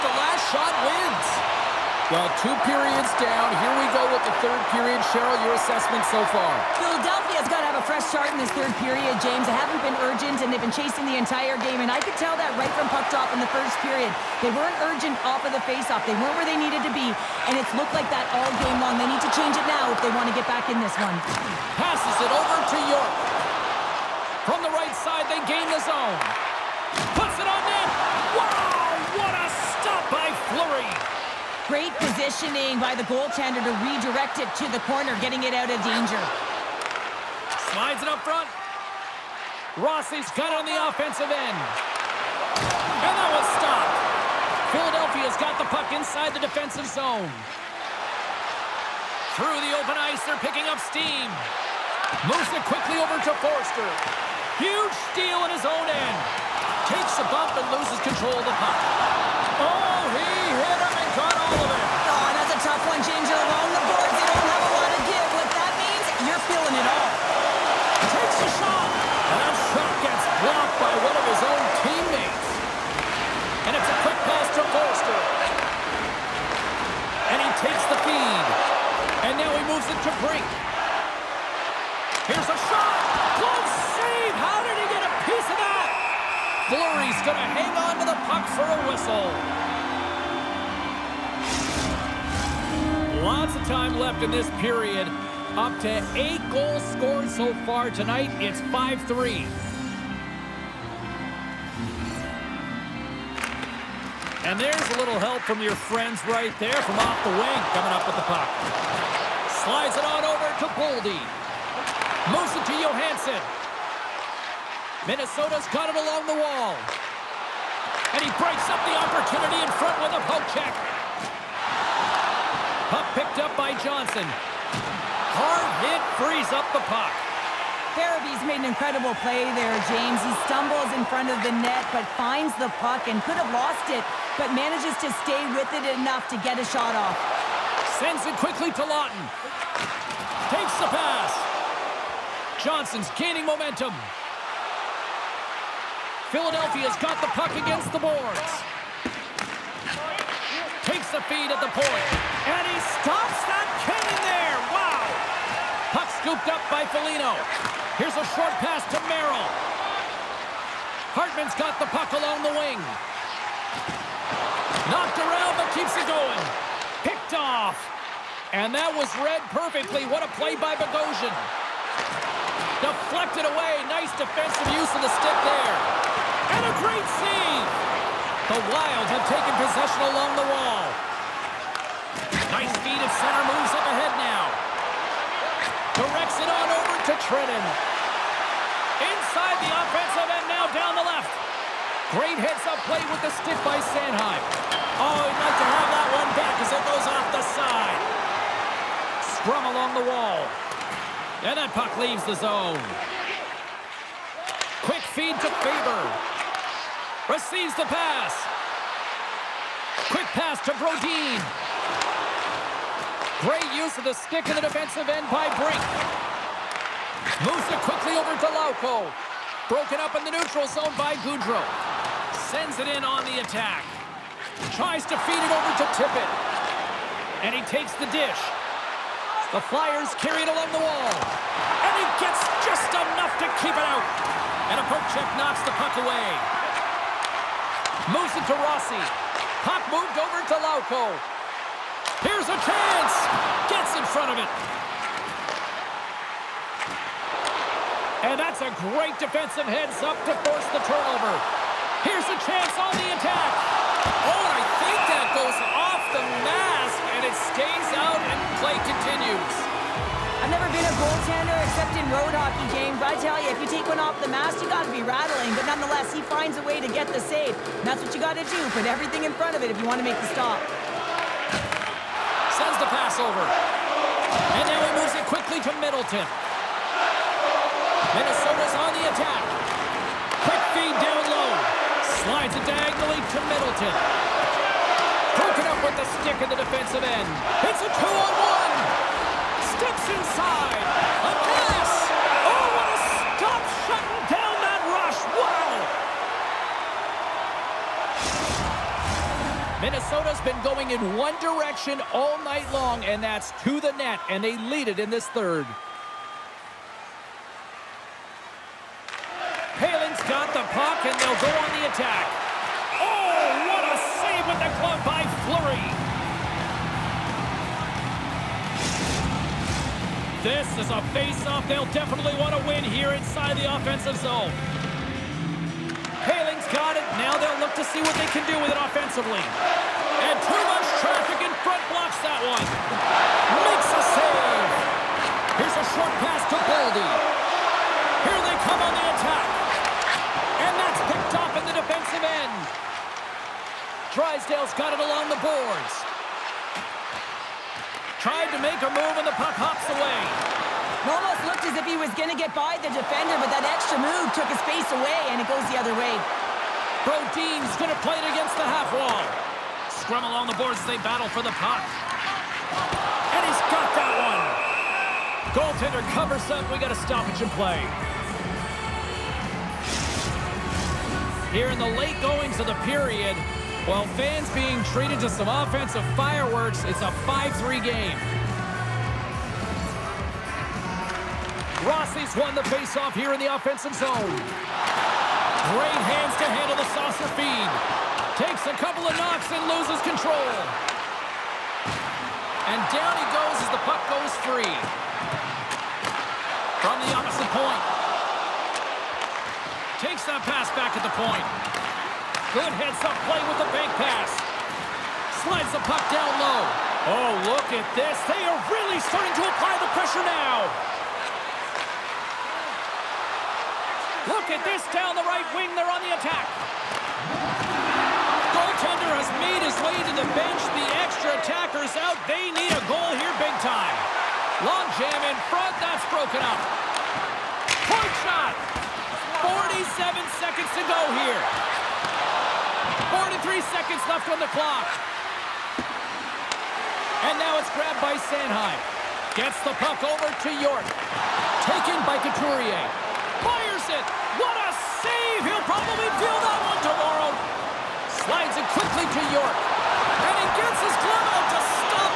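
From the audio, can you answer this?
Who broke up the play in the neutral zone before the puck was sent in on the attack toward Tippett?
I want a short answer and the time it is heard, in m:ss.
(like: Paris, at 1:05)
Gaudreau, at 3:41.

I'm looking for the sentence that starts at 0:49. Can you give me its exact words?
Through the open ice, they're picking up steam.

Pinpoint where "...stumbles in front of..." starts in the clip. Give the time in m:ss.
2:10.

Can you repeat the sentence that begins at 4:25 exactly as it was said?
But nonetheless, he finds a way to get the save.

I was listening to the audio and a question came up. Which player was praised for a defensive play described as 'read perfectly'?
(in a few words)
Bogosian.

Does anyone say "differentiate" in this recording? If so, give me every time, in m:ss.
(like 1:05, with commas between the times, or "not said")
not said.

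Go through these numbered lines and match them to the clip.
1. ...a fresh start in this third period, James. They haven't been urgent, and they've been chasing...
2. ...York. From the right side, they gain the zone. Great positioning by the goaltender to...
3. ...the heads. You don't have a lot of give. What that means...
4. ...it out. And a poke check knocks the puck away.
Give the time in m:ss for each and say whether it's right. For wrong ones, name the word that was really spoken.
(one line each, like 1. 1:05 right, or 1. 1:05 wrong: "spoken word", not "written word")
1. 0:07 right
2. 0:22 right
3. 1:03 wrong: "boards", not "heads"
4. 3:53 right.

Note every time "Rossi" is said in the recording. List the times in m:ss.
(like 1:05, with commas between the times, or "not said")
0:39, 3:58, 6:21.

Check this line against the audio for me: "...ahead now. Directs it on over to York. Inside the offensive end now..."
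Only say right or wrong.
wrong.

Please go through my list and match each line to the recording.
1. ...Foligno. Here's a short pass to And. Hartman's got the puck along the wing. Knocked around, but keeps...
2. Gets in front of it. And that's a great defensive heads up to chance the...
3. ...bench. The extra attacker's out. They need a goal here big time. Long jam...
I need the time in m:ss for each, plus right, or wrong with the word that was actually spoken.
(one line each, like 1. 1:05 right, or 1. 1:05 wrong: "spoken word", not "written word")
1. 2:36 wrong: "Merrill", not "And"
2. 4:03 wrong: "force", not "chance"
3. 7:00 right.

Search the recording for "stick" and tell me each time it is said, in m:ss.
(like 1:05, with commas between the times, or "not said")
2:55, 3:13, 3:34, 4:46.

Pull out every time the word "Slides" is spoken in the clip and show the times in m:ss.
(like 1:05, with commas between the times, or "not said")
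0:37, 1:49, 4:42, 6:45, 7:28.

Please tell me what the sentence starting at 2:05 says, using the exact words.
Hard hit frees up the puck.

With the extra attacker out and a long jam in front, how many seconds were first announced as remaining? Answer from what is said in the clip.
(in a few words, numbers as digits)
47.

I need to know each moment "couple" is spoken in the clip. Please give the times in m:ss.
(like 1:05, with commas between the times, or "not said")
6:28.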